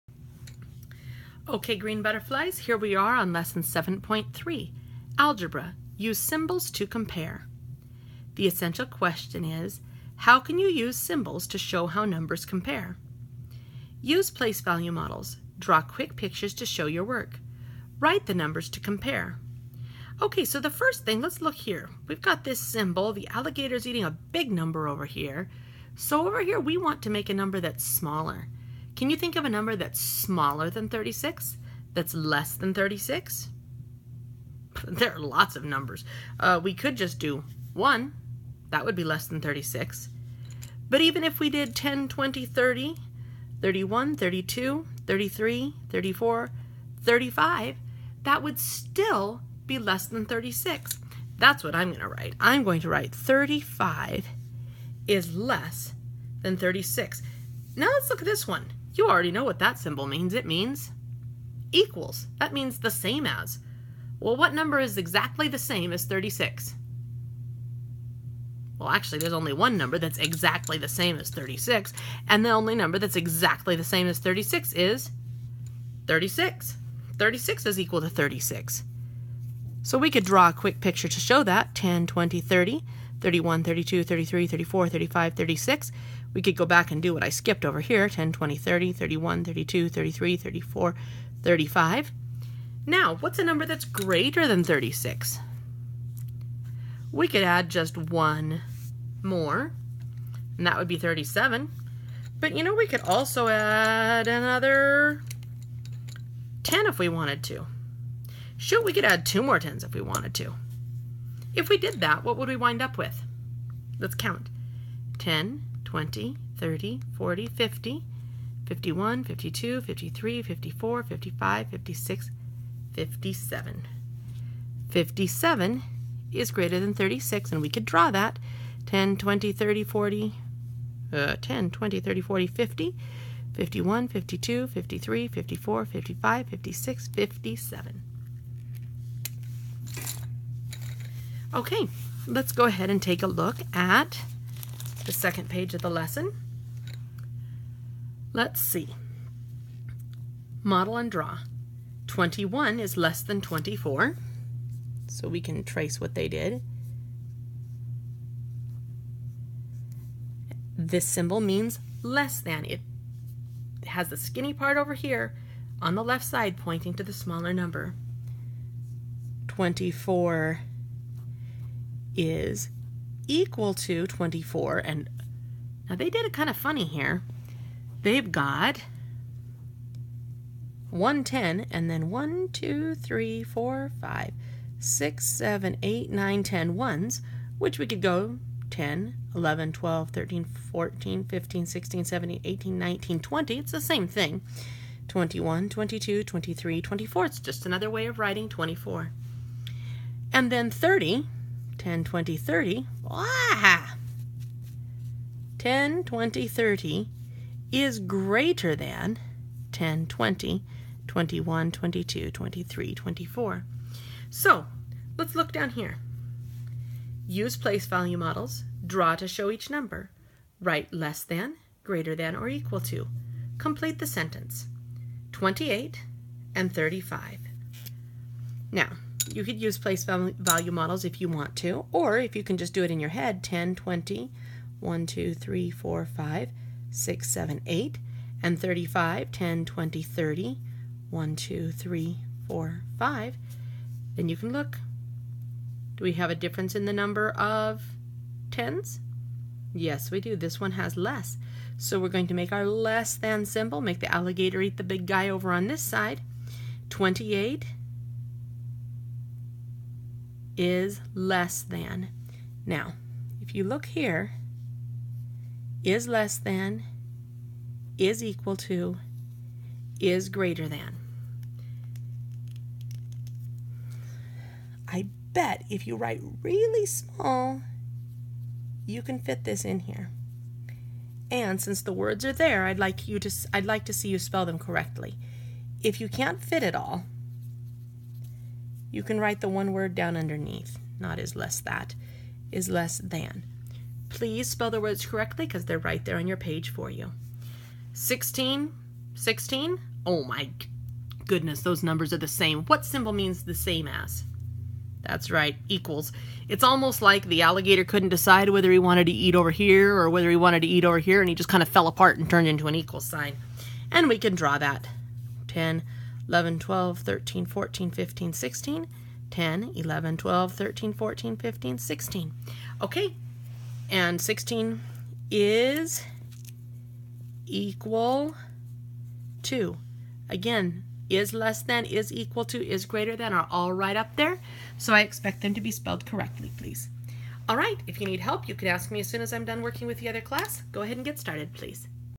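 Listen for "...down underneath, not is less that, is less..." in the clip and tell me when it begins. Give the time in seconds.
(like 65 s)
289 s.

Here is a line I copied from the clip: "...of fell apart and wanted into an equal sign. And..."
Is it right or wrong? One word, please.
wrong.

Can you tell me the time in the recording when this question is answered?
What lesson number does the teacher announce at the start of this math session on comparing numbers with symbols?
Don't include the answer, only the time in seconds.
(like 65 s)
3 s.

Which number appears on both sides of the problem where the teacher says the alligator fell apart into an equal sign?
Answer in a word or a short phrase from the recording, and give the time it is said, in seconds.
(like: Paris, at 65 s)
16, at 297 s.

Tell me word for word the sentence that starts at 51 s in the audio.
That's what I'm going to write.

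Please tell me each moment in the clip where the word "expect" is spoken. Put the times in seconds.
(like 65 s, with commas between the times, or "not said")
335 s.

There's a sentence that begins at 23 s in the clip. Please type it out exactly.
The alligator's eating a big number over here.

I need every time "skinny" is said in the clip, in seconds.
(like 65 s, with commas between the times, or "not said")
164 s.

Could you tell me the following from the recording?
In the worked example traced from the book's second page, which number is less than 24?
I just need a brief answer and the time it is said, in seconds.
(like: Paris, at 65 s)
21, at 152 s.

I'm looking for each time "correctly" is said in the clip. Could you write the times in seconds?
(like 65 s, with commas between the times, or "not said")
284 s, 295 s, 336 s.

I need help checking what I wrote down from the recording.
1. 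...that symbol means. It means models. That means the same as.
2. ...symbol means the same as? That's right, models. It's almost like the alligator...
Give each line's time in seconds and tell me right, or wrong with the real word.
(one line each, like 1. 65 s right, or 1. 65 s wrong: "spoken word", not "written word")
1. 59 s wrong: "equals", not "models"
2. 302 s wrong: "equals", not "models".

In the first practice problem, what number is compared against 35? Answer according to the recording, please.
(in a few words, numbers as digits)
28.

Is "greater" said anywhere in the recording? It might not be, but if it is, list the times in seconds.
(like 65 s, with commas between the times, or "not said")
93 s, 207 s, 221 s, 270 s, 332 s.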